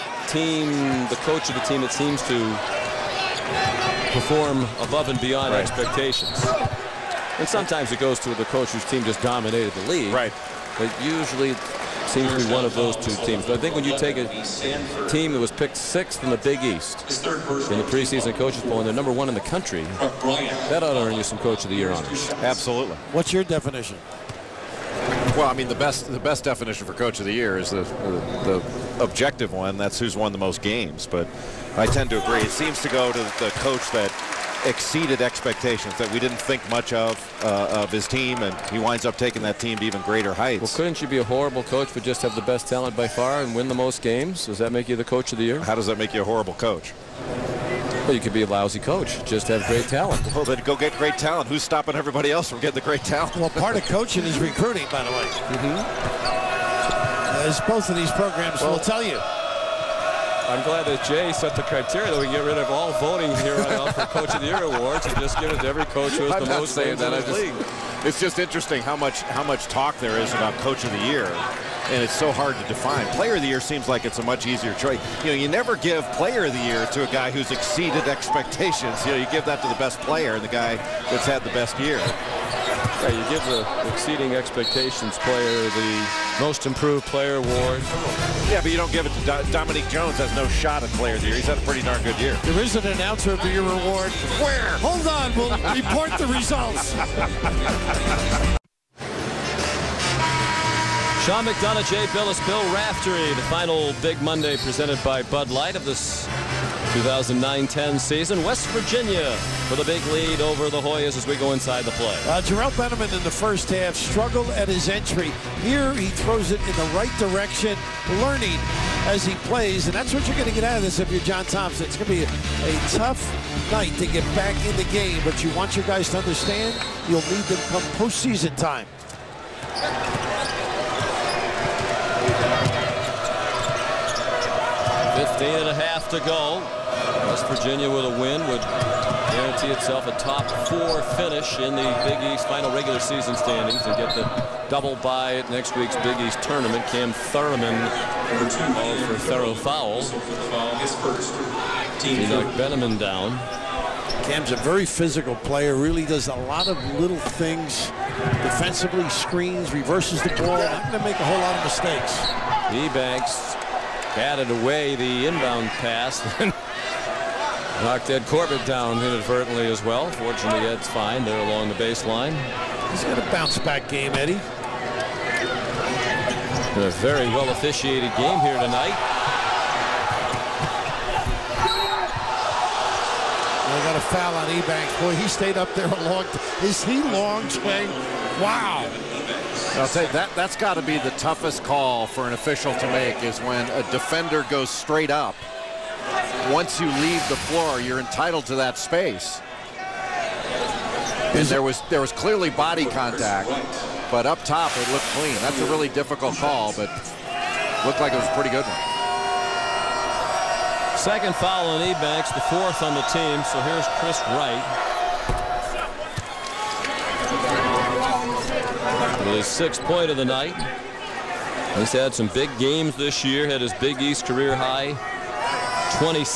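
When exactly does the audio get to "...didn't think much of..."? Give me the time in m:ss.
0:36.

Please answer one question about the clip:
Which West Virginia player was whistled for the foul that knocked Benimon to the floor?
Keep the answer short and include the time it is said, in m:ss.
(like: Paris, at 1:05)
Cam Thoroughman, at 2:26.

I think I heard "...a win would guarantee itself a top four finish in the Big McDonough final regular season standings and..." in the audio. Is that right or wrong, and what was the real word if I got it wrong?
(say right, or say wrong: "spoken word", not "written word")
wrong: "East", not "McDonough".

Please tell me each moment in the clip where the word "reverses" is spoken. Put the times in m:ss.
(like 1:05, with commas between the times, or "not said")
2:39.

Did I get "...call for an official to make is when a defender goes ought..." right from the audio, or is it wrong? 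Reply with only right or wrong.
wrong.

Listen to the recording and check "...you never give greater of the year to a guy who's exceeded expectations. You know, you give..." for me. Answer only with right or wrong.
wrong.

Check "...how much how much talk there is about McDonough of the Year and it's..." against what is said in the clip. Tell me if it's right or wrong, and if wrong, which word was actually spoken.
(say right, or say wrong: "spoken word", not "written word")
wrong: "Coach", not "McDonough".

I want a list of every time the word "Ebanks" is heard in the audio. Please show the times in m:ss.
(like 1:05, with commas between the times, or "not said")
2:42, 3:04, 3:31.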